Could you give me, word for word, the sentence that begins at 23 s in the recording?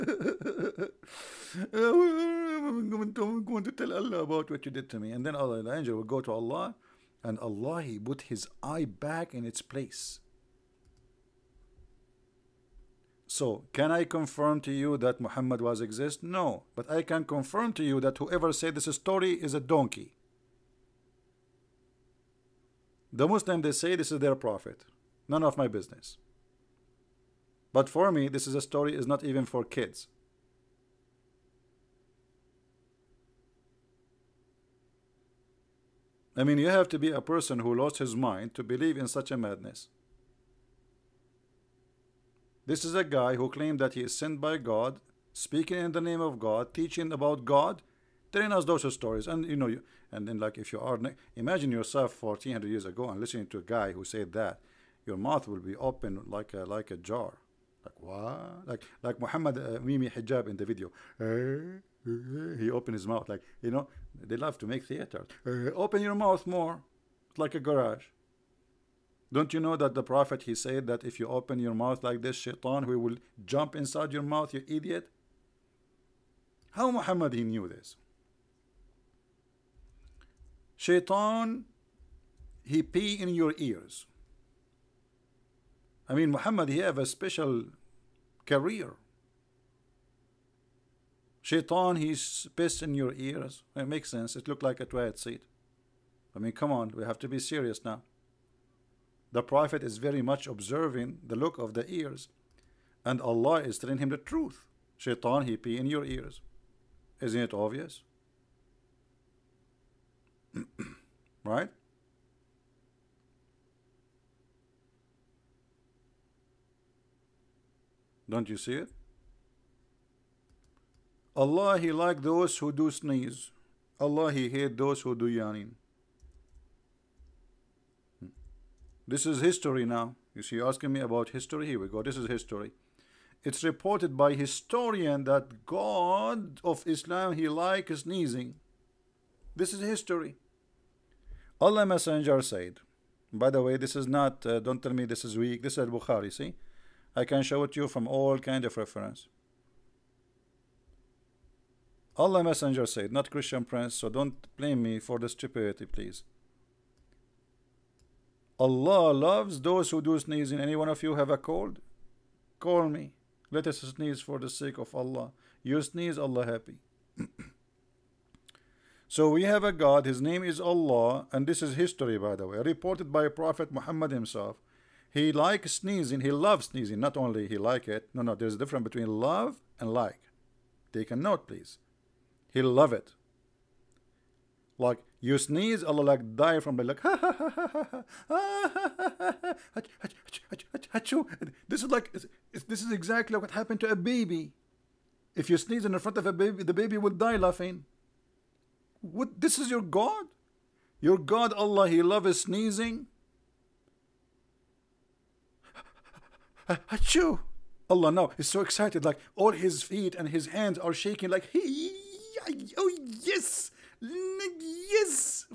The Muslim, they say this is their prophet.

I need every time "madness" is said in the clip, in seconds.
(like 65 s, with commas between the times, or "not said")
39 s.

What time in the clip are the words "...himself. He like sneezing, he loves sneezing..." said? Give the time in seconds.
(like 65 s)
174 s.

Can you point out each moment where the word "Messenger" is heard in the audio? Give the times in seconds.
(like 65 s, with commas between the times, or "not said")
141 s, 152 s.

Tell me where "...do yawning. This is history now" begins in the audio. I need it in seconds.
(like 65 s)
125 s.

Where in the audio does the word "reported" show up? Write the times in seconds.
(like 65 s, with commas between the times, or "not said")
133 s, 172 s.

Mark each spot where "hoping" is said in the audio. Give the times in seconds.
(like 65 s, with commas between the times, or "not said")
not said.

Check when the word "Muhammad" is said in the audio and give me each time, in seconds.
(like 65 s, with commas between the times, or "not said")
15 s, 59 s, 76 s, 86 s, 173 s.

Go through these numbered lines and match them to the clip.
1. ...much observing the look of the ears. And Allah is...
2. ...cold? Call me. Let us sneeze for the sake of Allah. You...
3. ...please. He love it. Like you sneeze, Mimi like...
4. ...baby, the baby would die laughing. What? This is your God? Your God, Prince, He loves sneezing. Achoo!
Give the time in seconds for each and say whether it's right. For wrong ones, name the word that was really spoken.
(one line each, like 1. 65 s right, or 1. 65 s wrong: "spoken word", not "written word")
1. 100 s right
2. 161 s right
3. 181 s wrong: "Allah", not "Mimi"
4. 196 s wrong: "Allah", not "Prince".